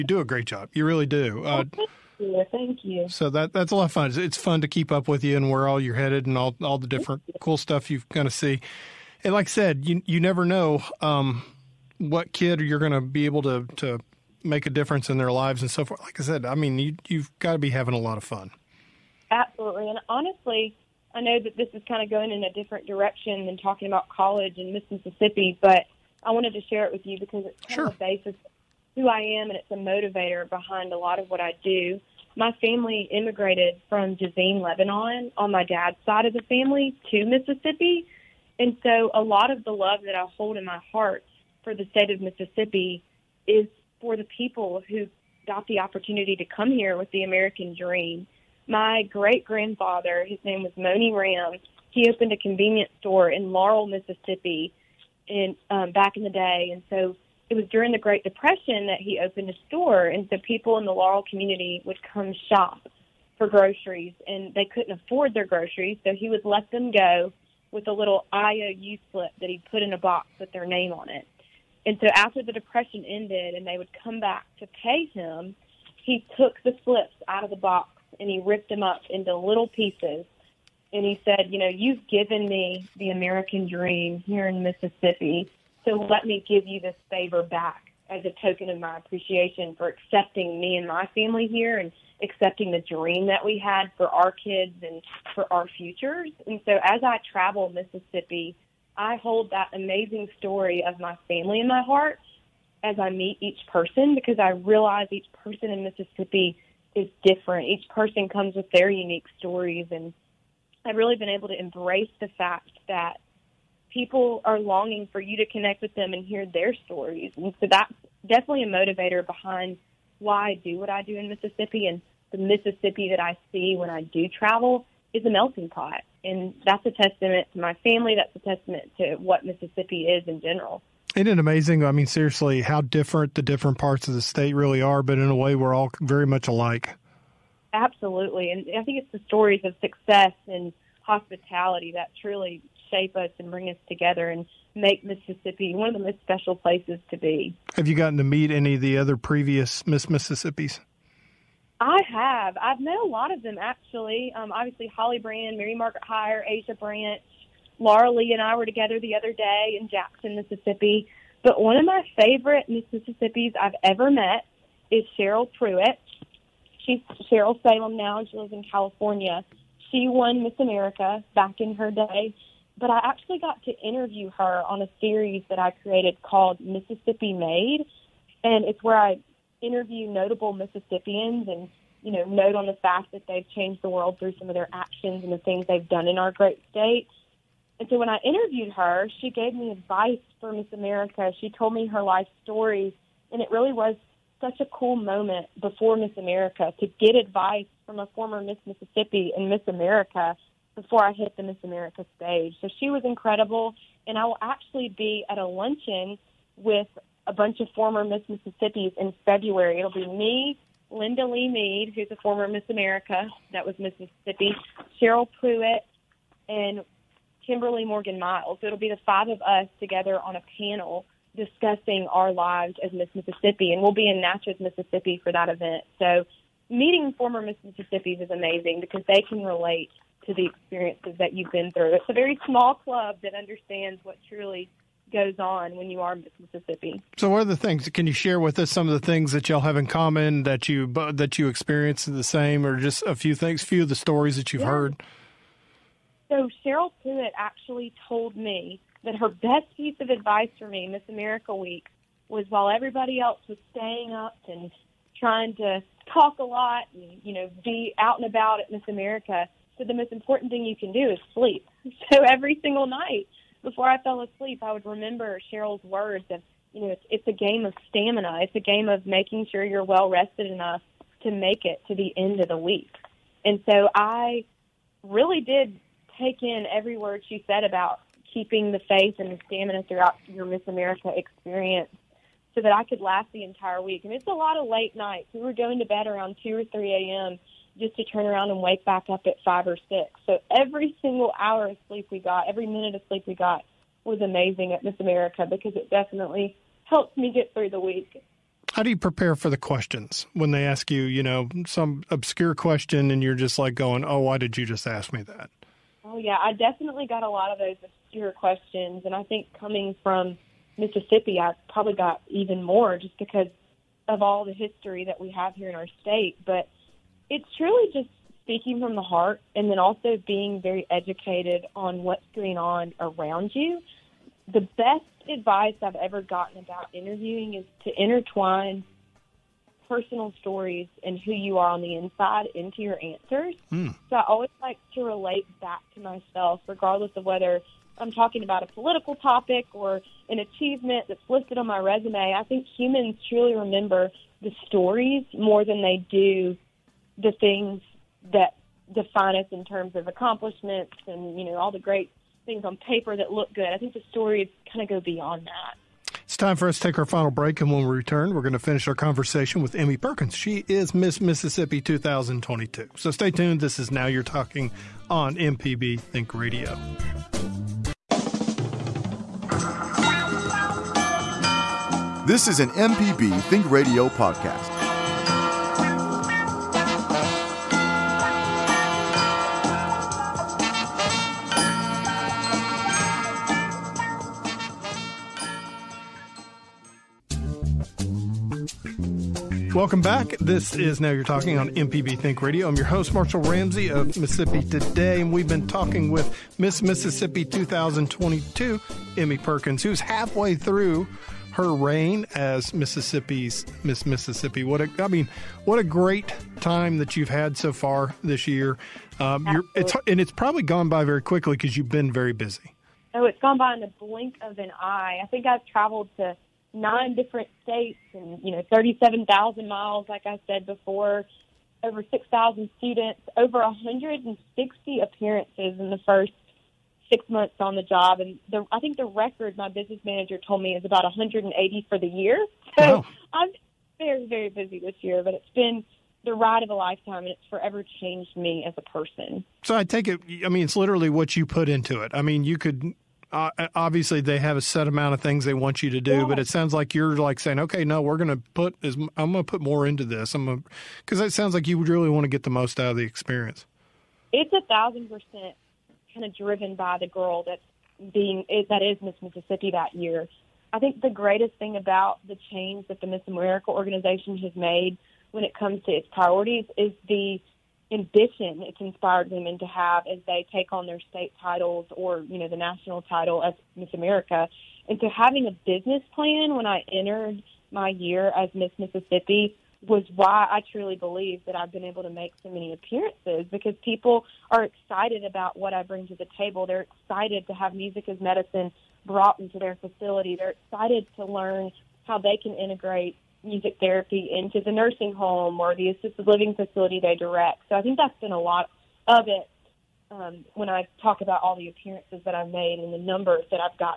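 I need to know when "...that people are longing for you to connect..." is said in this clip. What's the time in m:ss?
1:52.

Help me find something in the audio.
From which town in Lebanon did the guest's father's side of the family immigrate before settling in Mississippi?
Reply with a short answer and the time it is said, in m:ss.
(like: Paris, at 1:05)
Jezzine, at 0:34.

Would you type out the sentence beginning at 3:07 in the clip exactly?
And so when I interviewed her, she gave me advice for Miss America.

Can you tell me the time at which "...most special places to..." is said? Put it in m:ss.
2:26.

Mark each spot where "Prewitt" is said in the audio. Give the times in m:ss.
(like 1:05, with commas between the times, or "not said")
2:45, 3:35, 4:07.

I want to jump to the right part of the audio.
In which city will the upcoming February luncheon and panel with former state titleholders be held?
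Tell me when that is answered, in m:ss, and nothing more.
3:44.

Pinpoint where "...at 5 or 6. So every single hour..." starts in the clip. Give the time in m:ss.
4:49.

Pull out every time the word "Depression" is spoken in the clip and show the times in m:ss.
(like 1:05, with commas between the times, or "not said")
0:58, 1:12.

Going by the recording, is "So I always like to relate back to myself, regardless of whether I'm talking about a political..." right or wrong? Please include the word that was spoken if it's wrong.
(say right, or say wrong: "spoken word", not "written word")
right.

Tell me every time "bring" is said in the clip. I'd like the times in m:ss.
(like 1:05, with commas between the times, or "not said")
2:23, 8:05.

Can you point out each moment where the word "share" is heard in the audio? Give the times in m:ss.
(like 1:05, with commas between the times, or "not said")
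0:26, 3:58.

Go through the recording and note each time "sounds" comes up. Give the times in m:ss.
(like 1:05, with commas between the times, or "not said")
7:26, 7:31.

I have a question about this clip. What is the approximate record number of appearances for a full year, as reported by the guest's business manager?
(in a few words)
180.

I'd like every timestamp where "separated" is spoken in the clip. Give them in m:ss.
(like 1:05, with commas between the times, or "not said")
not said.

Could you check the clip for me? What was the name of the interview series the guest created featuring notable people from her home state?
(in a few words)
Mississippi Made.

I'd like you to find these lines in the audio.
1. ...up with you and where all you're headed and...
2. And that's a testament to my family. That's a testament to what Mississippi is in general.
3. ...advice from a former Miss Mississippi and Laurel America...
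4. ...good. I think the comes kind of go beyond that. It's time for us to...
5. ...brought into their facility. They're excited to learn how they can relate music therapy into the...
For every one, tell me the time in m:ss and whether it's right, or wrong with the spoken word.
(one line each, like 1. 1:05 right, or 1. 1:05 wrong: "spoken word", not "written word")
1. 0:04 right
2. 2:06 right
3. 3:17 wrong: "Miss", not "Laurel"
4. 5:53 wrong: "stories", not "comes"
5. 8:09 wrong: "integrate", not "relate".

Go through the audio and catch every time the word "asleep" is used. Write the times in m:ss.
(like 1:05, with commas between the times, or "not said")
4:24.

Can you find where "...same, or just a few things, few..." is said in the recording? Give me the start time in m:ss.
4:02.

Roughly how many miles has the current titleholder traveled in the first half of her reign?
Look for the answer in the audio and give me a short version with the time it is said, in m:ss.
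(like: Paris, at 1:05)
37,000, at 6:58.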